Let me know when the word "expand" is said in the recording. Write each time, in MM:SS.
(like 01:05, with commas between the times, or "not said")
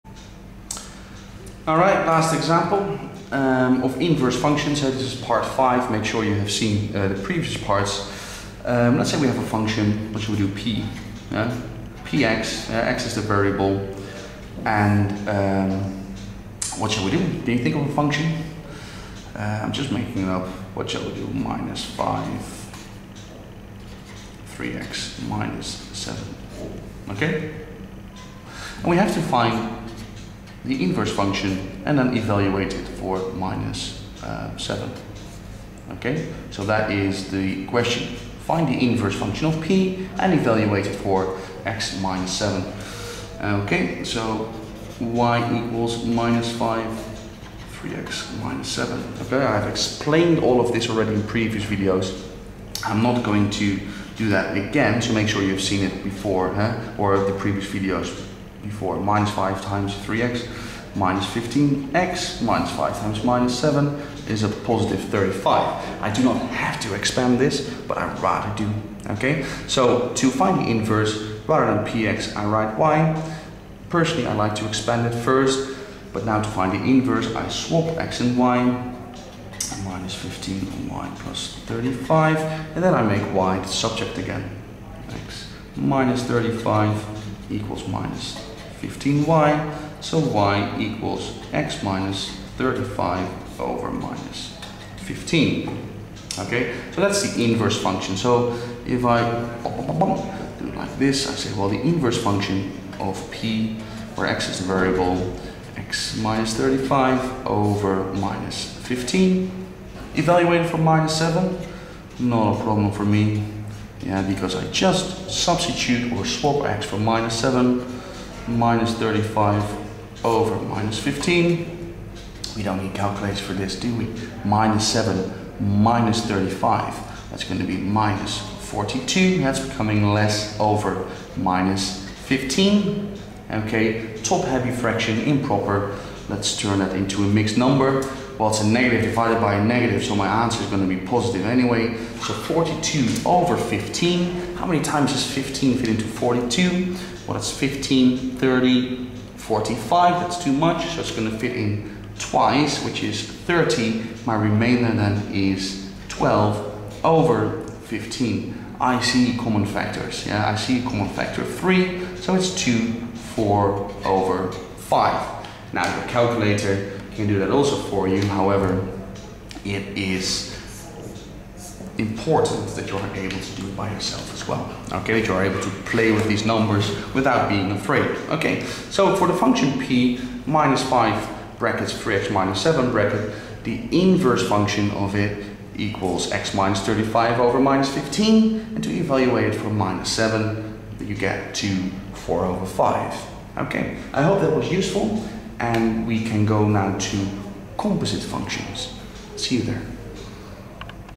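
01:06, 01:14.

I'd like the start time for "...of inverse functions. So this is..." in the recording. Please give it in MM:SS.
00:03.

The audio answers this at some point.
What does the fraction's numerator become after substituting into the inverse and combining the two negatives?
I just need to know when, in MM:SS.
02:07.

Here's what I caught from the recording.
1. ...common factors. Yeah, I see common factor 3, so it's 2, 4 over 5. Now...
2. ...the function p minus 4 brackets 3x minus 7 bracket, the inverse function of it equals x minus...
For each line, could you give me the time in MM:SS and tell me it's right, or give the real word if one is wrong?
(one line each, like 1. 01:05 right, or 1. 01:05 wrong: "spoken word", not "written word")
1. 02:39 right
2. 02:59 wrong: "5", not "4".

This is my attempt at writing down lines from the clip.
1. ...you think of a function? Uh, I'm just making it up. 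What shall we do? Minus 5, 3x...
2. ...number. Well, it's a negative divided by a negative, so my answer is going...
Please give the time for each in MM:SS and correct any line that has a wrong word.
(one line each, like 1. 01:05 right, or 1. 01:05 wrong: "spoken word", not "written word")
1. 00:17 right
2. 02:17 right.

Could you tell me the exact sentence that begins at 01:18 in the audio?
And minus 15 on y plus 35, and then I make y the subject again.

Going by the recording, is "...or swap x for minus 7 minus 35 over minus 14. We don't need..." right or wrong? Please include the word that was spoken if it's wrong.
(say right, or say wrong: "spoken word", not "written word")
wrong: "15", not "14".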